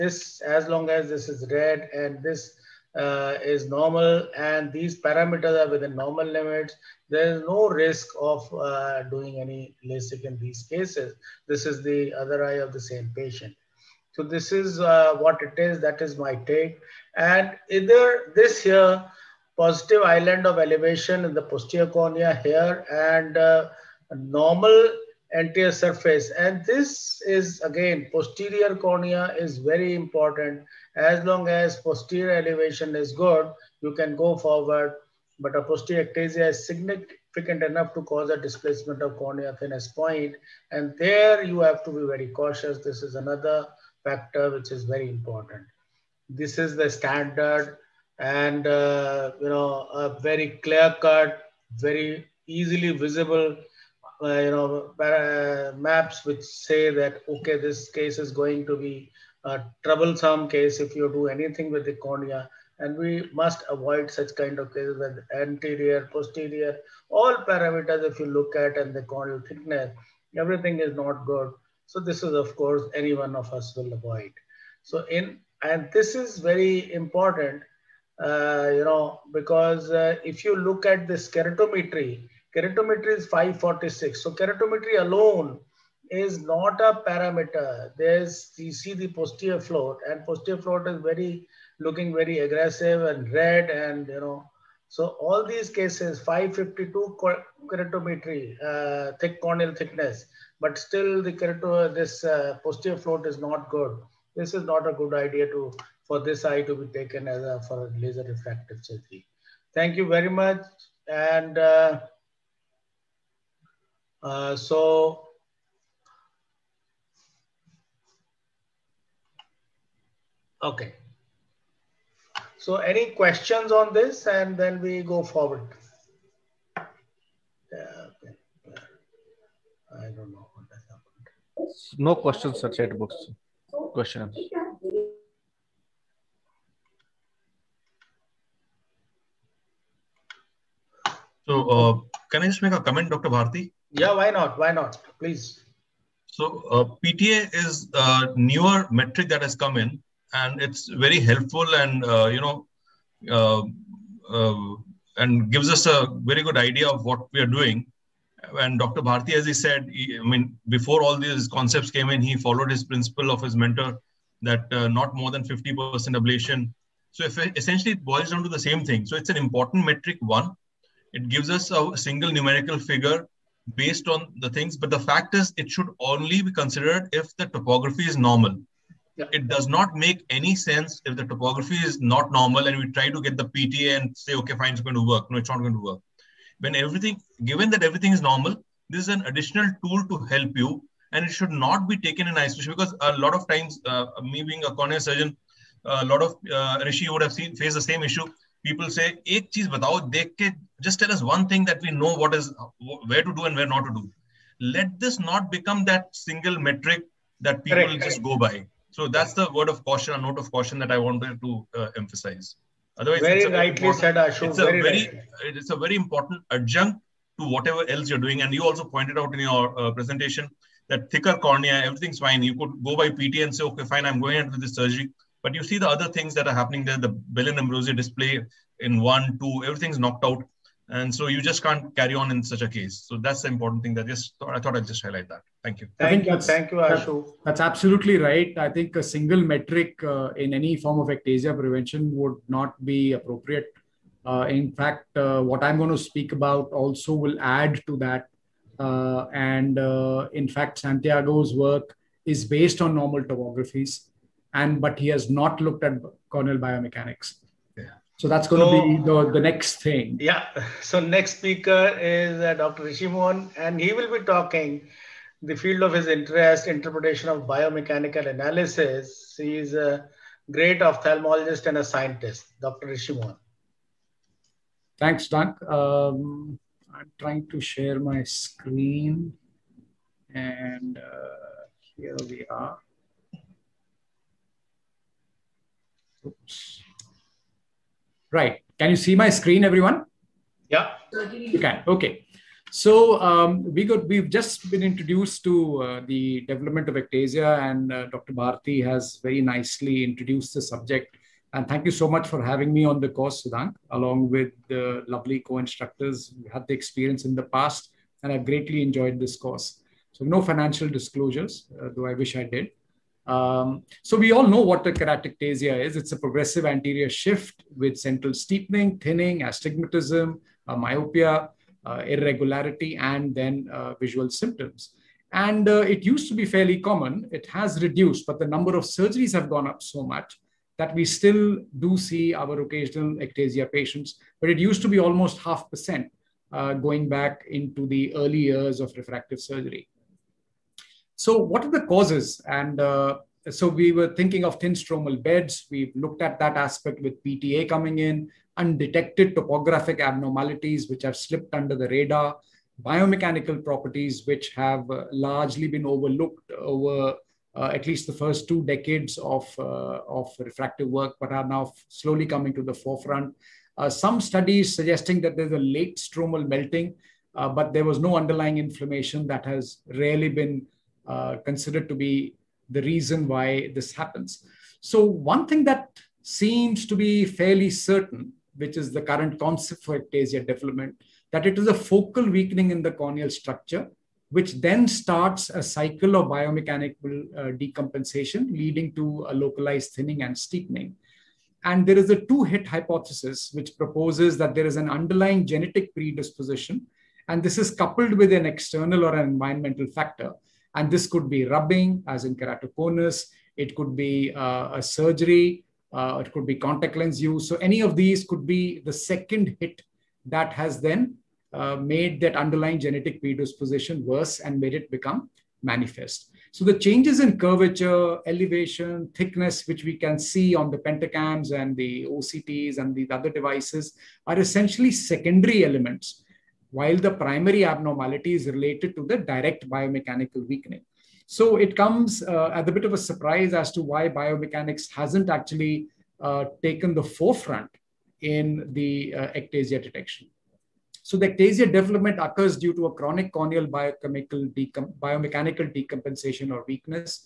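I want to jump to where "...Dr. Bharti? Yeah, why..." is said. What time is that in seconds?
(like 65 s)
143 s.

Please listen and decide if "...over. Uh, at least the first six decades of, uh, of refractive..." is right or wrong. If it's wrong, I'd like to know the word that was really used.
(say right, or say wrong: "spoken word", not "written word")
wrong: "two", not "six".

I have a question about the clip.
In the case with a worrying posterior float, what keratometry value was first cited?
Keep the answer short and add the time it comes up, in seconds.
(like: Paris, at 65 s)
546, at 83 s.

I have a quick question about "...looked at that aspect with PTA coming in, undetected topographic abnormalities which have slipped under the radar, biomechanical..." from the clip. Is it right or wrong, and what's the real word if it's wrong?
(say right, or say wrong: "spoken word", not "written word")
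right.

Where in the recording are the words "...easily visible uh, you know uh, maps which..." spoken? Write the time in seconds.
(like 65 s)
52 s.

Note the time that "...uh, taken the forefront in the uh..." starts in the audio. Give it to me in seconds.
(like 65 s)
436 s.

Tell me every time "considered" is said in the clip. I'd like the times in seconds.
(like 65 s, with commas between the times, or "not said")
176 s, 371 s.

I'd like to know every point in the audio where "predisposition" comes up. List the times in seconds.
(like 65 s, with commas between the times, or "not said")
395 s, 413 s.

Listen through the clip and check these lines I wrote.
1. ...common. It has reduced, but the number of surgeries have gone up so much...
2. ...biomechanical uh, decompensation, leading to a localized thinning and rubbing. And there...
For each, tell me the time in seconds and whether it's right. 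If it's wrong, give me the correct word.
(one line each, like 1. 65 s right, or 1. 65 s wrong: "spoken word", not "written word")
1. 326 s right
2. 386 s wrong: "steepening", not "rubbing".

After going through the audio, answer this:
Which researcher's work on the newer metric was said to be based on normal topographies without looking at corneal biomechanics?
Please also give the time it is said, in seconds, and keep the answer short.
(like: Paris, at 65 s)
Santhiago, at 250 s.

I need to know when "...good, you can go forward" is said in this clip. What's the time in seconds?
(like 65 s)
33 s.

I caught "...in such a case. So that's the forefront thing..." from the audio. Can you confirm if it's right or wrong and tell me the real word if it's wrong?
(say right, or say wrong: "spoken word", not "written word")
wrong: "important", not "forefront".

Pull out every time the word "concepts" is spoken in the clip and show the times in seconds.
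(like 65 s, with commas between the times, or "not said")
161 s, 379 s.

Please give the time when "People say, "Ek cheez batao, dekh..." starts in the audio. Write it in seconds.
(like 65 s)
198 s.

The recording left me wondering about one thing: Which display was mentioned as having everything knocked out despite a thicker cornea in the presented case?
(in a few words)
Belin Ambrosio display.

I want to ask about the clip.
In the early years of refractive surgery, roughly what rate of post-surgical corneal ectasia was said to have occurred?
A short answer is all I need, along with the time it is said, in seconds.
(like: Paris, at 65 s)
half percent, at 335 s.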